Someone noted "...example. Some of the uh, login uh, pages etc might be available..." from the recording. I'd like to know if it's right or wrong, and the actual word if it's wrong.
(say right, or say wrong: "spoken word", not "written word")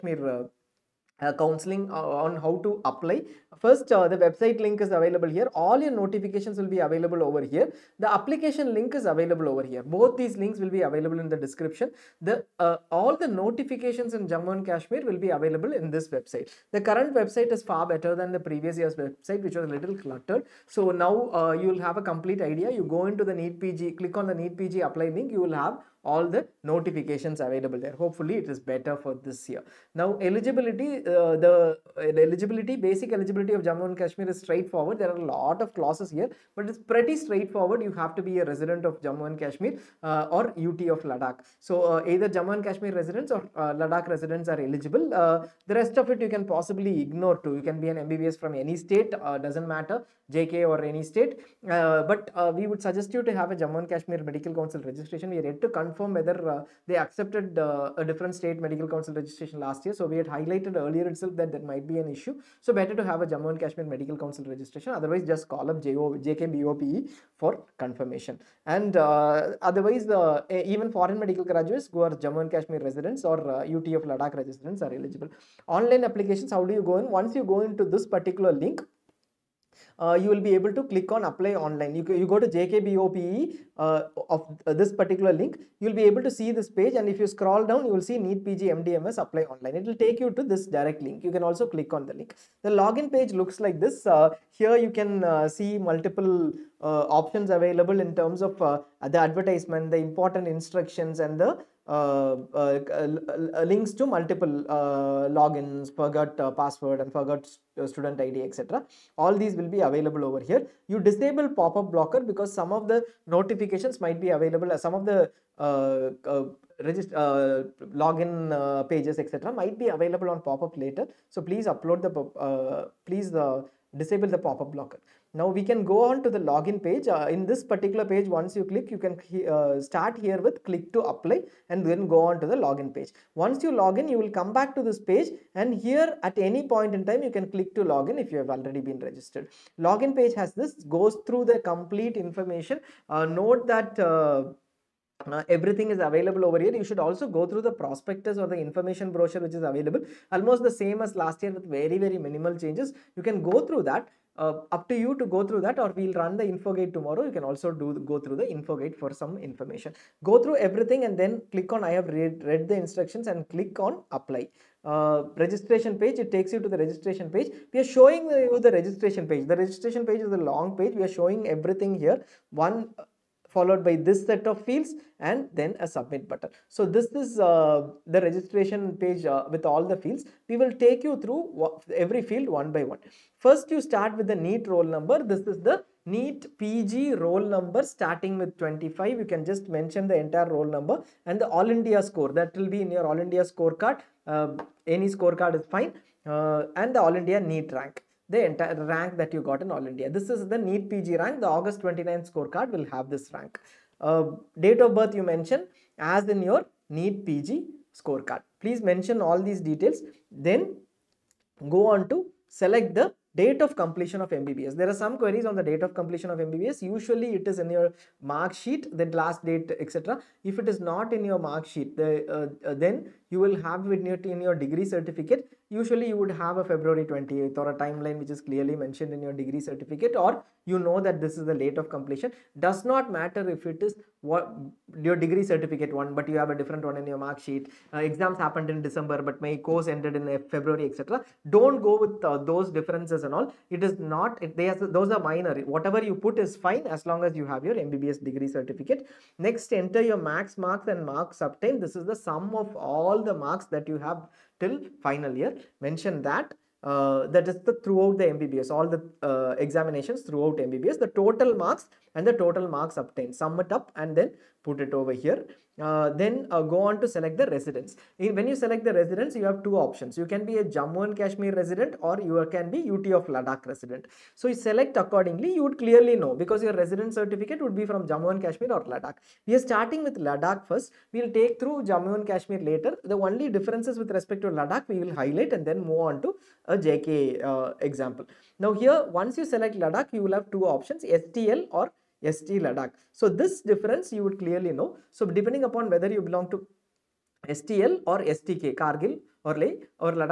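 wrong: "available", not "example".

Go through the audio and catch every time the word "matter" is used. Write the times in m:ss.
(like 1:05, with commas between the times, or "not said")
0:49, 3:53.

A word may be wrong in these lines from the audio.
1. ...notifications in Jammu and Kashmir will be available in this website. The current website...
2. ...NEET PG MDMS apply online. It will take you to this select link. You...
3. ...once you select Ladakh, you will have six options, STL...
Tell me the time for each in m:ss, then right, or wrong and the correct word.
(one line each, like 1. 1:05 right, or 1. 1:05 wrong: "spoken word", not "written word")
1. 0:13 right
2. 1:28 wrong: "direct", not "select"
3. 4:49 wrong: "two", not "six".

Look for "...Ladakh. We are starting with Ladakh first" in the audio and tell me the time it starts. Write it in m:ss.
4:38.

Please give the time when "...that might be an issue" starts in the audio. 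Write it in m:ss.
1:01.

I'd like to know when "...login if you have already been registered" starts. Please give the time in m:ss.
2:17.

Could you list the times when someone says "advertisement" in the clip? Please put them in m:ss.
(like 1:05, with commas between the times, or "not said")
1:39.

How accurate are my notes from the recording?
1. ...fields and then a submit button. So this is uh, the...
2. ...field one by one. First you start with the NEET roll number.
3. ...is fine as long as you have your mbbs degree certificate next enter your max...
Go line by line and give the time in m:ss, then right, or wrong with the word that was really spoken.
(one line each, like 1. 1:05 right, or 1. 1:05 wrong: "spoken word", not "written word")
1. 2:54 right
2. 3:02 right
3. 4:06 right.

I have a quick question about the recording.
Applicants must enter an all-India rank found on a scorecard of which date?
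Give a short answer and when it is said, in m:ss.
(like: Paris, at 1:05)
August 29, at 3:21.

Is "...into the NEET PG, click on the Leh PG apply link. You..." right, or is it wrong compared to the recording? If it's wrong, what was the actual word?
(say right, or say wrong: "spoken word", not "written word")
wrong: "NEET", not "Leh".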